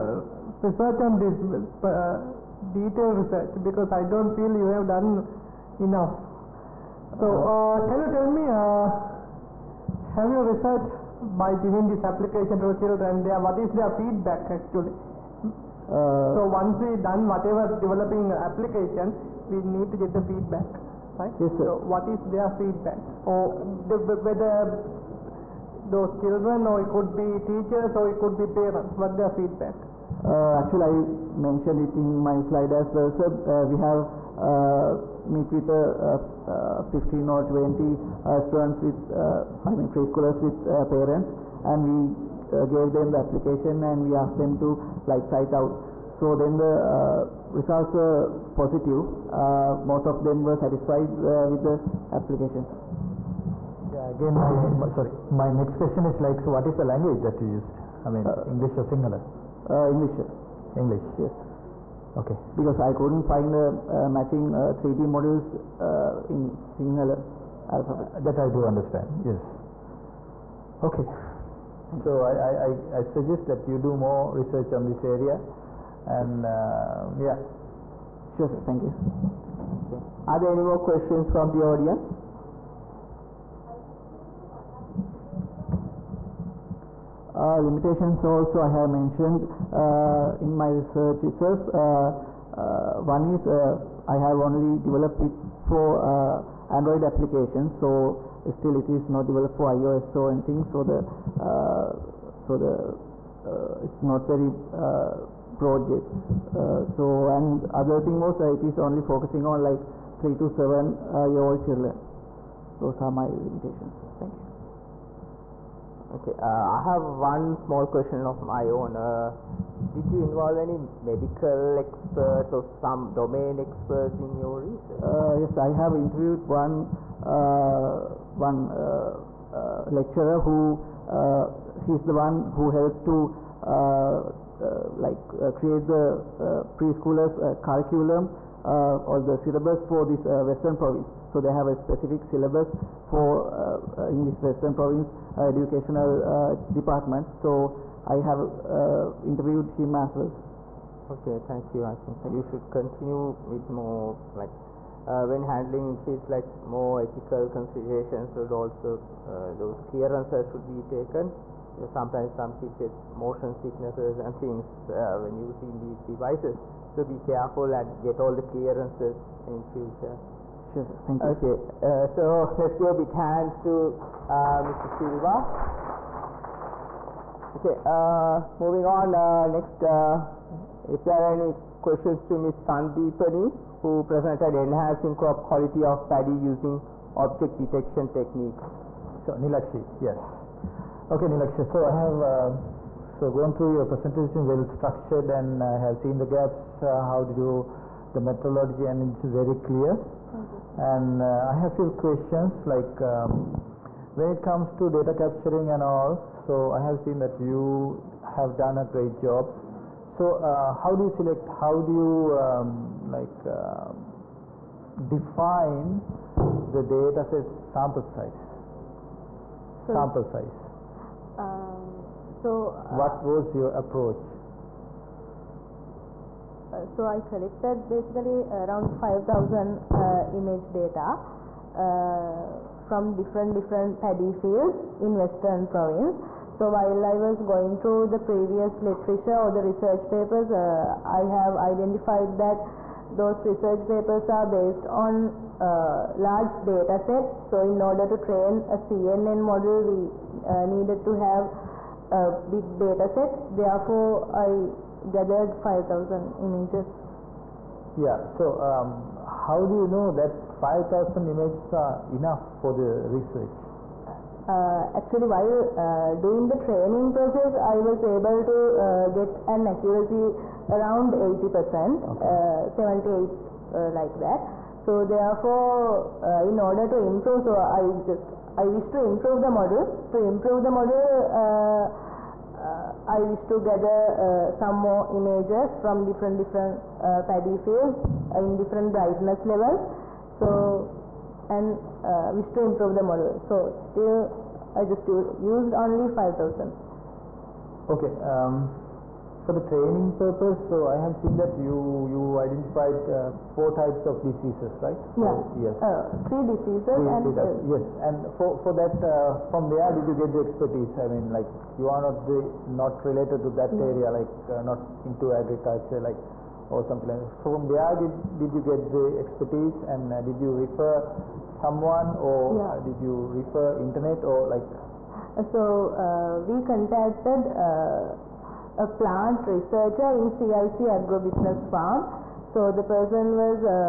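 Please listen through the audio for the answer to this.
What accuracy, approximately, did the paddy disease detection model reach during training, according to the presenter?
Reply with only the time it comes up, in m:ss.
4:31.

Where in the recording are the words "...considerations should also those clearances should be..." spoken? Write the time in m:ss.
2:37.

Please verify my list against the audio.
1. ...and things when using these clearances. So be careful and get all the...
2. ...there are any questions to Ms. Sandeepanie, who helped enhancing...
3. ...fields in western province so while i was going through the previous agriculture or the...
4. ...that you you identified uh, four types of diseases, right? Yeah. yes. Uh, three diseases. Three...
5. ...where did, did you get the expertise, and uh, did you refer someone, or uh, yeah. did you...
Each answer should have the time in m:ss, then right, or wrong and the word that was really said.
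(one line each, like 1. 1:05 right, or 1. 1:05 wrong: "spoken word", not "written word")
1. 2:44 wrong: "devices", not "clearances"
2. 3:01 wrong: "presented", not "helped"
3. 3:54 wrong: "literature", not "agriculture"
4. 5:01 right
5. 5:17 right.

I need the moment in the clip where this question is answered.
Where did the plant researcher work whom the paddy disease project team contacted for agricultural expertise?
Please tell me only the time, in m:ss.
5:30.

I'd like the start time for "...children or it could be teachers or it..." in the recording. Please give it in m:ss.
0:26.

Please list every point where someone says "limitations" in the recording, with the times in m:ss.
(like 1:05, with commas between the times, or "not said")
1:27, 1:53.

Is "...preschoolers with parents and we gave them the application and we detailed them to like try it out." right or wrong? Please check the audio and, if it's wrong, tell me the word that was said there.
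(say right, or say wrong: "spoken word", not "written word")
wrong: "asked", not "detailed".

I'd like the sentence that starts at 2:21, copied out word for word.
So they have a specific syllabus for uh, uh in this western province uh, educational uh, department.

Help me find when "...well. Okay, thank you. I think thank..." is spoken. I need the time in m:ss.
2:30.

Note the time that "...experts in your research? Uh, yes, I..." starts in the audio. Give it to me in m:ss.
2:03.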